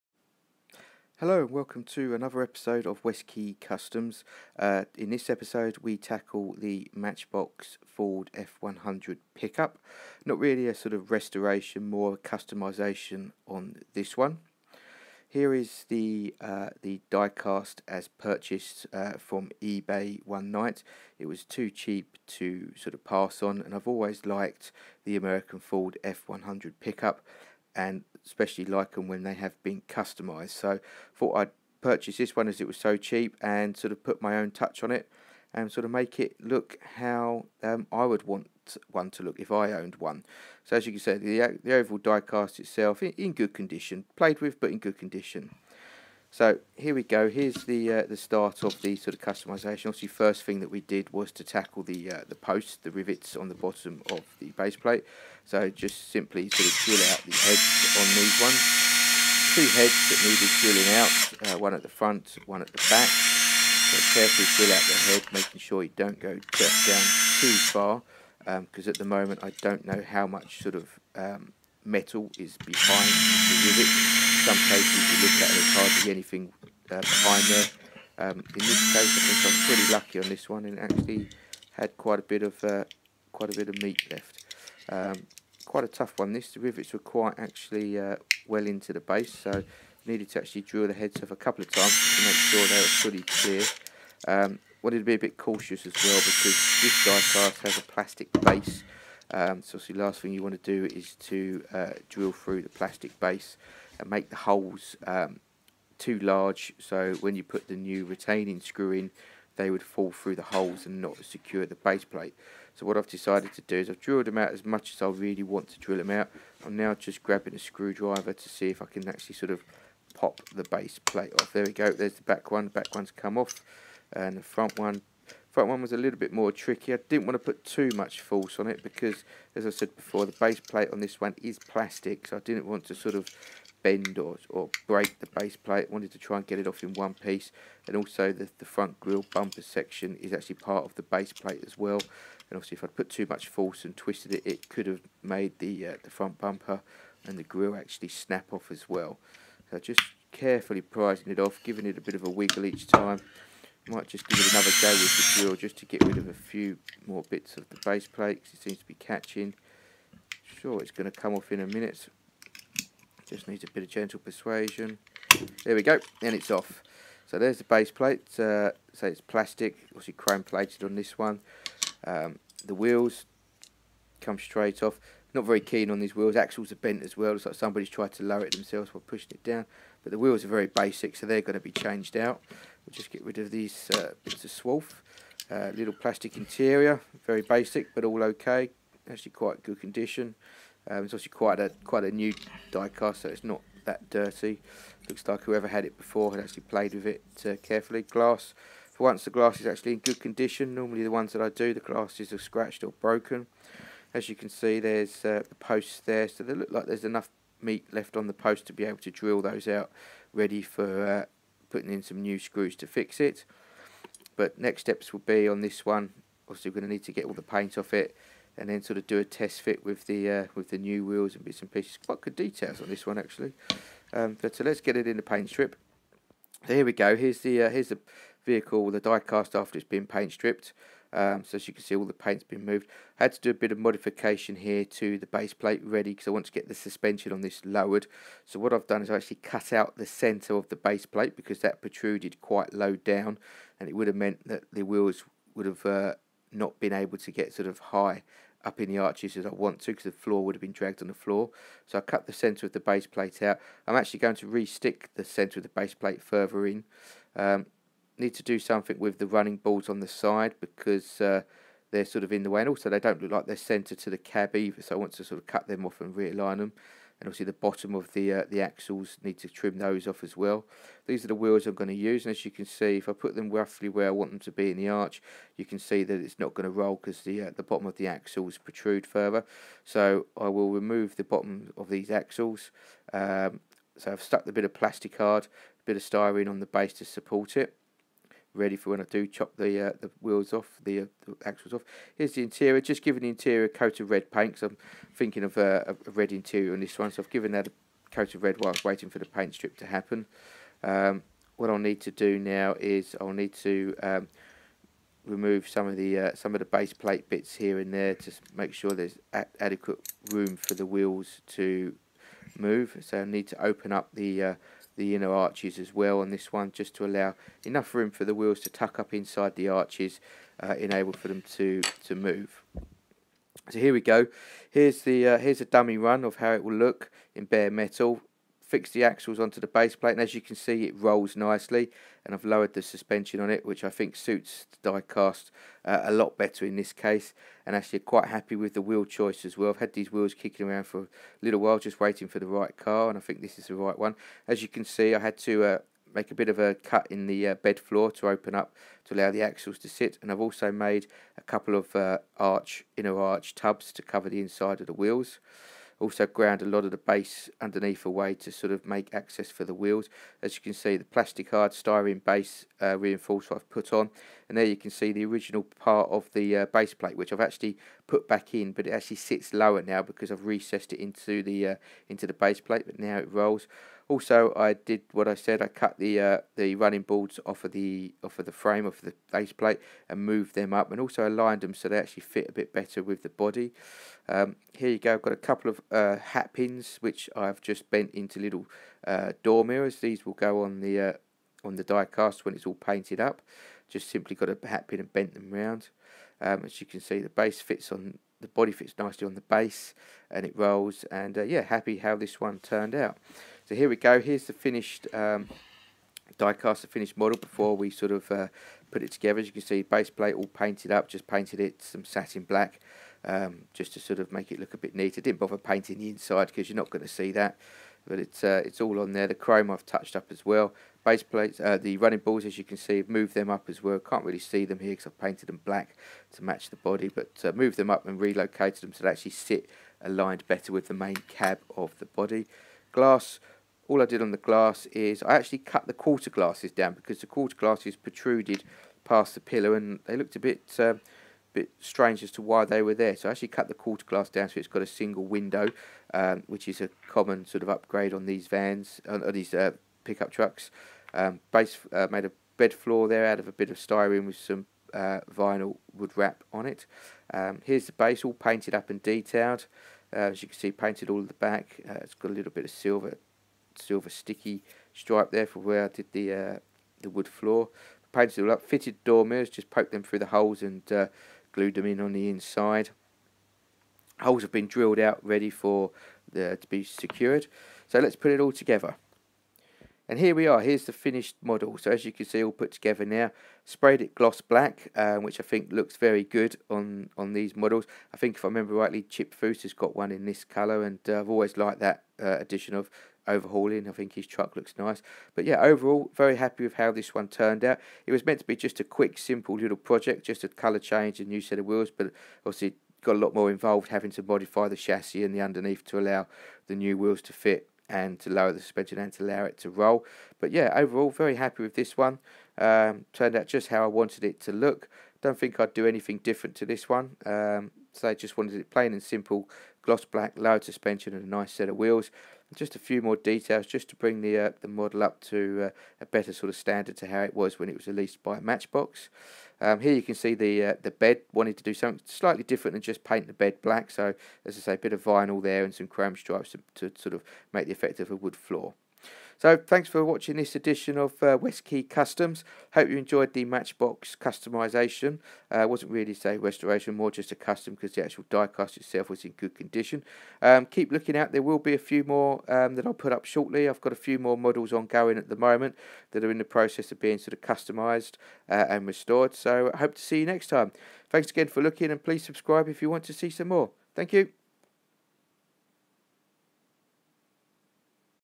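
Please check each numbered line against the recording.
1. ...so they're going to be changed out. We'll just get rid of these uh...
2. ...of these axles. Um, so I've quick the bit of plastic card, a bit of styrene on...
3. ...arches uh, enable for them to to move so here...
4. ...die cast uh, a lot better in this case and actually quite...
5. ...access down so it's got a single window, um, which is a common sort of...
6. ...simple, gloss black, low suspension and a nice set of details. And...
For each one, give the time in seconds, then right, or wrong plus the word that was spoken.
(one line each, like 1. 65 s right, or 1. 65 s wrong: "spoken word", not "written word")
1. 181 s right
2. 281 s wrong: "stuck", not "quick"
3. 319 s right
4. 334 s right
5. 444 s wrong: "glass", not "access"
6. 519 s wrong: "wheels", not "details".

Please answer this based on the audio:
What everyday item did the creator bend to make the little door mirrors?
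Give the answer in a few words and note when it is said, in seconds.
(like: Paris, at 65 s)
Hat pins, at 386 s.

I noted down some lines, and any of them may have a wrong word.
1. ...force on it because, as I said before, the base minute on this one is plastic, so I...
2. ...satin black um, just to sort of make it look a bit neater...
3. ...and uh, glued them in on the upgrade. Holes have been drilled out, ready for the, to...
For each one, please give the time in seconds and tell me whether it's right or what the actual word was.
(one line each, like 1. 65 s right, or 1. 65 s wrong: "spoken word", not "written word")
1. 128 s wrong: "plate", not "minute"
2. 412 s right
3. 470 s wrong: "inside", not "upgrade".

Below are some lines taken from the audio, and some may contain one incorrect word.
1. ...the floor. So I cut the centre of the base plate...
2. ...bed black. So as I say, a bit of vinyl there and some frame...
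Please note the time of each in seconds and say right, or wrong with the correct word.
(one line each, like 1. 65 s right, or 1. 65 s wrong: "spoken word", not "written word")
1. 251 s right
2. 533 s wrong: "chrome", not "frame".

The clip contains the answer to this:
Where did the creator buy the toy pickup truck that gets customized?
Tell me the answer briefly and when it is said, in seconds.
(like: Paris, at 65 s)
eBay, at 19 s.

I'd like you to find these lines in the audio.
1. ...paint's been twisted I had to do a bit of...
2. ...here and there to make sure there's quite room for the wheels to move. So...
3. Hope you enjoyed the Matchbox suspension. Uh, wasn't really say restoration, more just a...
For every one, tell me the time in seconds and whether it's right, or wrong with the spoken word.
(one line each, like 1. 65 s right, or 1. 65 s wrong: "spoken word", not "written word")
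1. 232 s wrong: "moved", not "twisted"
2. 307 s wrong: "adequate", not "quite"
3. 542 s wrong: "customisation", not "suspension".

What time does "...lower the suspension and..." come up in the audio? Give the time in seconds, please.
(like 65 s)
508 s.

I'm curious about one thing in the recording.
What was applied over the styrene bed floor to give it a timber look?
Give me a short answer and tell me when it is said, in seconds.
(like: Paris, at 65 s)
Vinyl wood wrap, at 455 s.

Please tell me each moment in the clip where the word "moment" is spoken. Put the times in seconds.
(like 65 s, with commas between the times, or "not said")
69 s, 555 s.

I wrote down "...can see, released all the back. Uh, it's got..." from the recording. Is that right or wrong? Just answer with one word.
wrong.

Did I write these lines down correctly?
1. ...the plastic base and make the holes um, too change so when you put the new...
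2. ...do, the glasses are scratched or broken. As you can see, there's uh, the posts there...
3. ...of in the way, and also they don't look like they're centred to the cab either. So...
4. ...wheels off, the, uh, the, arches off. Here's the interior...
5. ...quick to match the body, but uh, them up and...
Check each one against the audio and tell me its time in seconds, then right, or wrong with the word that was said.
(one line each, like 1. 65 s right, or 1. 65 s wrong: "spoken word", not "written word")
1. 102 s wrong: "large", not "change"
2. 201 s right
3. 262 s right
4. 290 s wrong: "axles", not "arches"
5. 425 s wrong: "black", not "quick".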